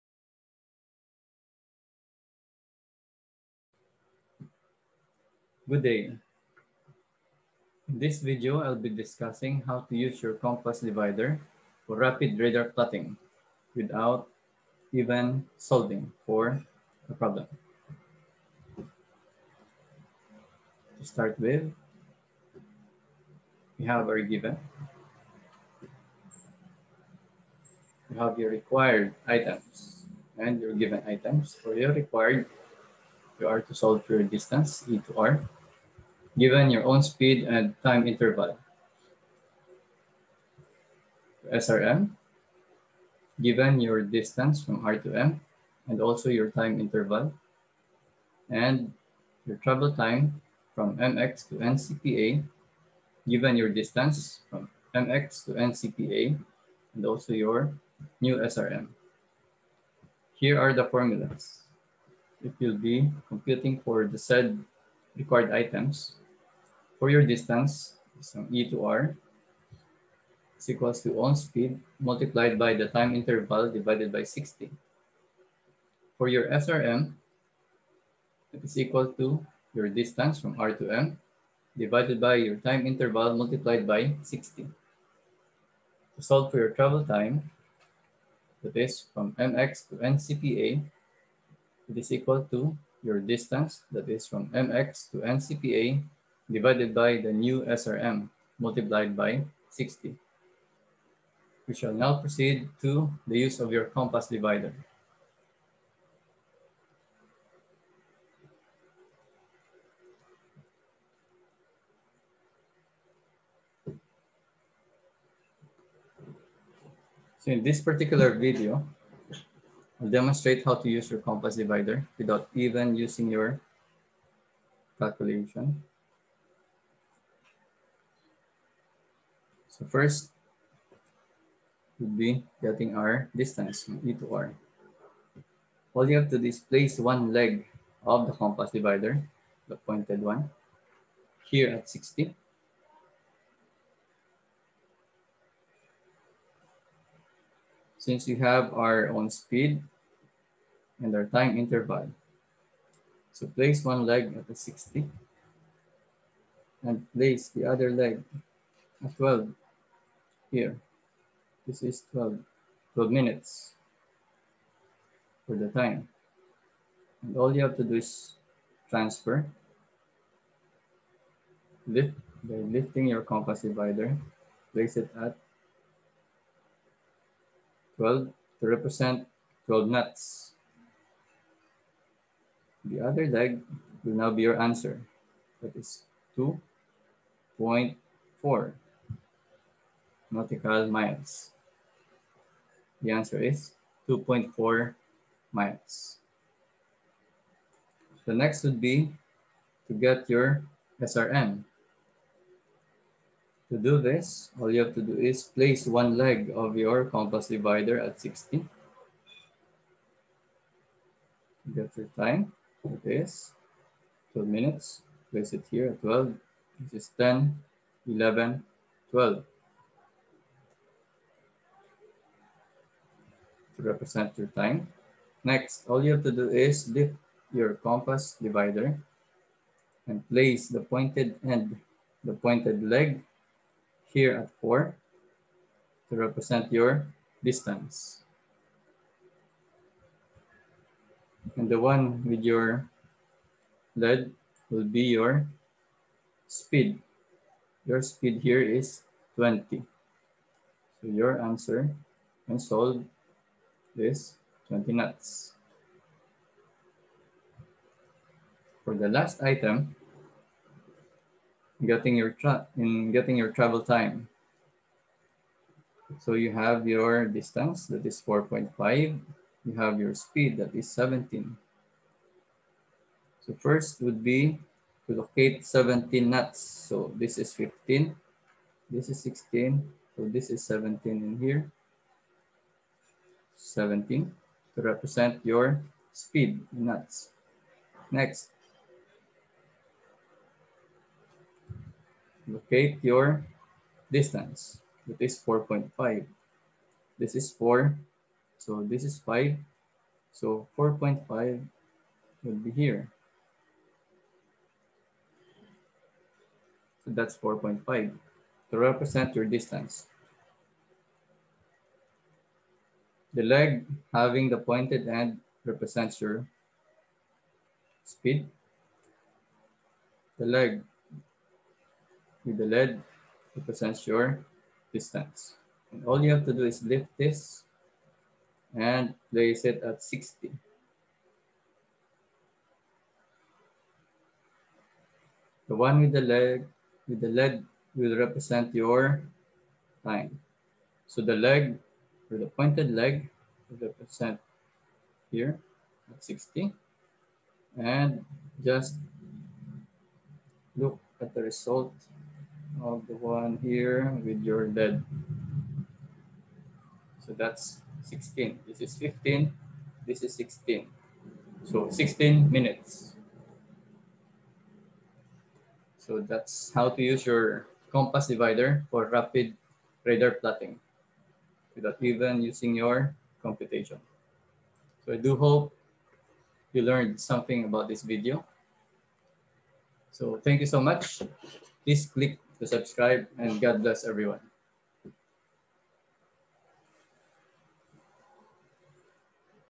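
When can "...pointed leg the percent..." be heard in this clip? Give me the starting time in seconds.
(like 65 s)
342 s.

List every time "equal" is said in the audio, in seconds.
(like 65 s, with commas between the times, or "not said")
70 s, 78 s, 92 s.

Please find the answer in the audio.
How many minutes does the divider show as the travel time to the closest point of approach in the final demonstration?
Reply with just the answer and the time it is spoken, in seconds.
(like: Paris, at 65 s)
16 minutes, at 361 s.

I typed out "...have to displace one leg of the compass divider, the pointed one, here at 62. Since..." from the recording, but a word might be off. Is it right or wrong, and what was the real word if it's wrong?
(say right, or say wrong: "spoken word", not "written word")
wrong: "60", not "62".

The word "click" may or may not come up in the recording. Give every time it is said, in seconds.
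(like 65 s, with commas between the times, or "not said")
382 s.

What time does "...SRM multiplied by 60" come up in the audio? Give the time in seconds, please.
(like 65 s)
97 s.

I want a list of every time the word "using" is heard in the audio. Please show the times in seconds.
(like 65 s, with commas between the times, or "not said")
122 s, 372 s.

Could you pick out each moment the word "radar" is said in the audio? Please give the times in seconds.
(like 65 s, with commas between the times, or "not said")
12 s, 370 s.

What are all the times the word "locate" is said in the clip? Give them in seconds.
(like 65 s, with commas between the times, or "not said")
275 s, 292 s.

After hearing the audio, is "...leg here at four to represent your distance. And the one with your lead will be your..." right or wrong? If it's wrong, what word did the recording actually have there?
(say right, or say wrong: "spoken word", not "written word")
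right.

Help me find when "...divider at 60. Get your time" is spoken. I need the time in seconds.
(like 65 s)
207 s.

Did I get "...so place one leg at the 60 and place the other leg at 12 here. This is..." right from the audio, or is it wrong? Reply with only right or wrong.
right.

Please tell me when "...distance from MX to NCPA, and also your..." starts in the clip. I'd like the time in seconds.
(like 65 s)
53 s.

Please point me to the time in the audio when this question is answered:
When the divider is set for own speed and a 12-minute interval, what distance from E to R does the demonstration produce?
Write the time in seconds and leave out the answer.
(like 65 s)
194 s.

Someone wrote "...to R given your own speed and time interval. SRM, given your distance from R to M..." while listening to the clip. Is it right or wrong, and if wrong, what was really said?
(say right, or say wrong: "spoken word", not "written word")
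right.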